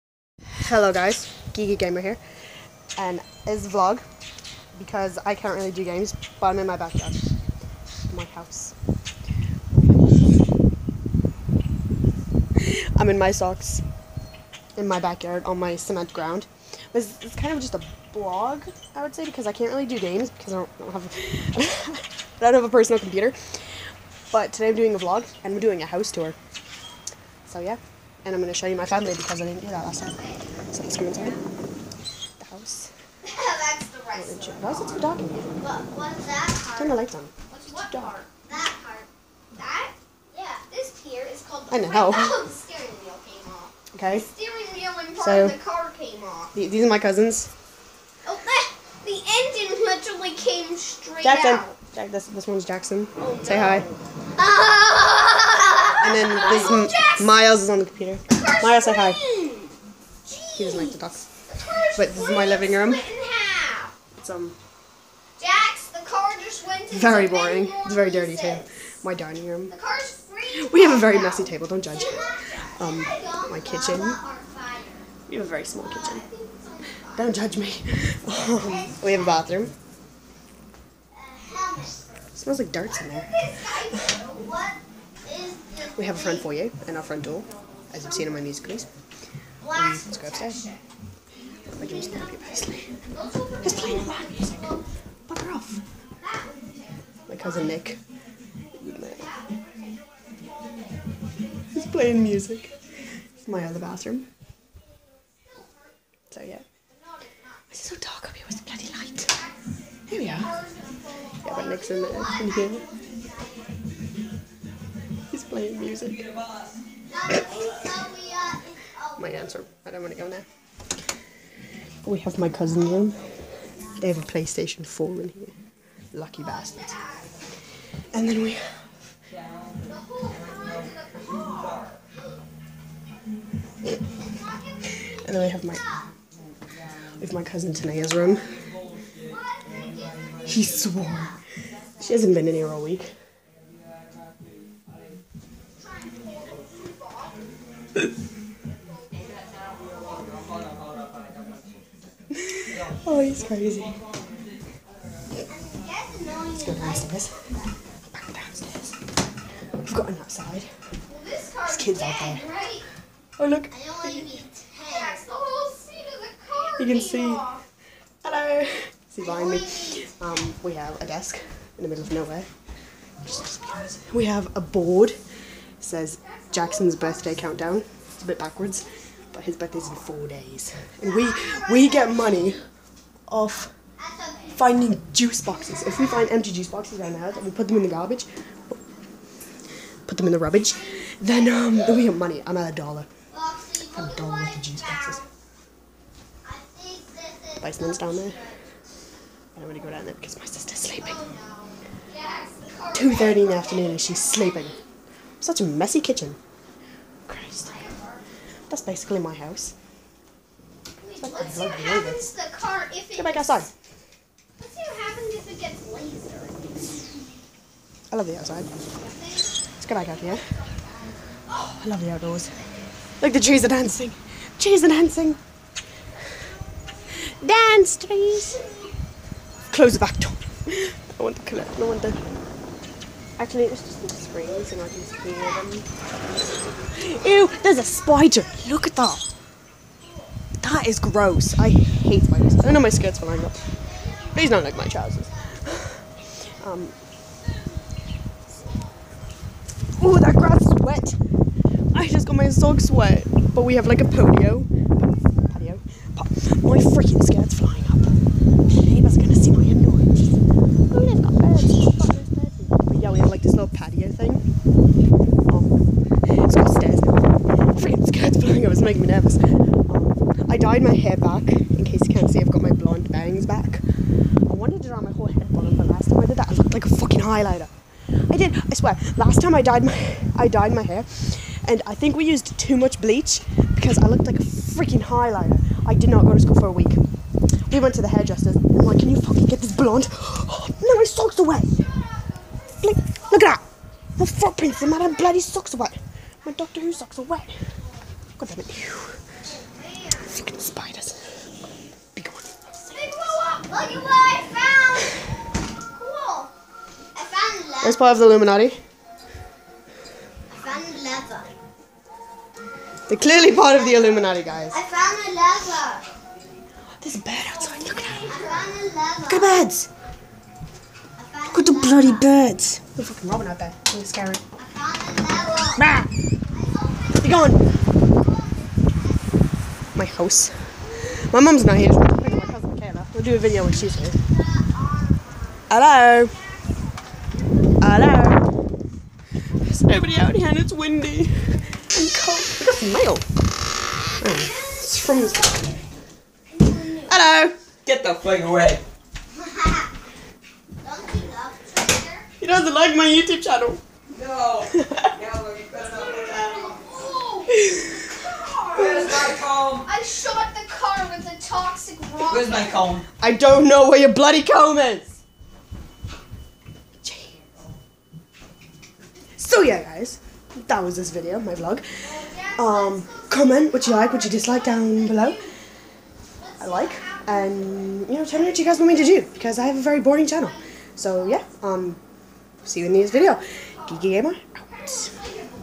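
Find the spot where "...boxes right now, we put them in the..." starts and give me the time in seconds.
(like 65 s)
186 s.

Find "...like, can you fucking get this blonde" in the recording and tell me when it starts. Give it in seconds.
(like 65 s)
288 s.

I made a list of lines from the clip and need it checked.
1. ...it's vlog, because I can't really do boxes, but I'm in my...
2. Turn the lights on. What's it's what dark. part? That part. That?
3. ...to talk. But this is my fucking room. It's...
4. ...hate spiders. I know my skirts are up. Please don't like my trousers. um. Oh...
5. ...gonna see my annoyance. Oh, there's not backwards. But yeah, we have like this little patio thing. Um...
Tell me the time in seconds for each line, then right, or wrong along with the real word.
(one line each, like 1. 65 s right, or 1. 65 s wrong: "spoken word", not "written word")
1. 3 s wrong: "games", not "boxes"
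2. 36 s right
3. 60 s wrong: "living", not "fucking"
4. 241 s right
5. 259 s wrong: "birds", not "backwards".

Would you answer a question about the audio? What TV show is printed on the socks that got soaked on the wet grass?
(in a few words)
Doctor Who.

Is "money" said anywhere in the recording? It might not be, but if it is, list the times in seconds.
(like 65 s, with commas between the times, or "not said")
182 s, 192 s.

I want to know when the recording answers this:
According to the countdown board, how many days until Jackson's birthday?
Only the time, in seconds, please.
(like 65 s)
179 s.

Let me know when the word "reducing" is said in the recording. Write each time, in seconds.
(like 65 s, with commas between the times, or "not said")
not said.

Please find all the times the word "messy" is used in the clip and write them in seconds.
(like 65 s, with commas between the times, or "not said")
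71 s, 205 s.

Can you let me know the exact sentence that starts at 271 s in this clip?
In case you can't see, I've got my blonde bangs back.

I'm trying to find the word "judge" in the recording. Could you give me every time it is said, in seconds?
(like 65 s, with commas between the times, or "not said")
71 s, 77 s.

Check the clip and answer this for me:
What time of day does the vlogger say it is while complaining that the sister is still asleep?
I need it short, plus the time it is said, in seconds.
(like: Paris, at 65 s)
2:30, at 202 s.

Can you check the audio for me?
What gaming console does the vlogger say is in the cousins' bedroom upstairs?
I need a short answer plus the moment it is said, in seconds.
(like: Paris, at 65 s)
PlayStation 4, at 124 s.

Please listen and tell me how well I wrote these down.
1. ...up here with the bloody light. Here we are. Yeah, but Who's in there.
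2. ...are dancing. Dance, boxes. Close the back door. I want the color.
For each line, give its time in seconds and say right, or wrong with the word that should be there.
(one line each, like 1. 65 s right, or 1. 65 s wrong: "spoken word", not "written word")
1. 108 s wrong: "Nick", not "Who"
2. 224 s wrong: "trees", not "boxes".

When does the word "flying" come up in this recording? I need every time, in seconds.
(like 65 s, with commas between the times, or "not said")
257 s, 268 s.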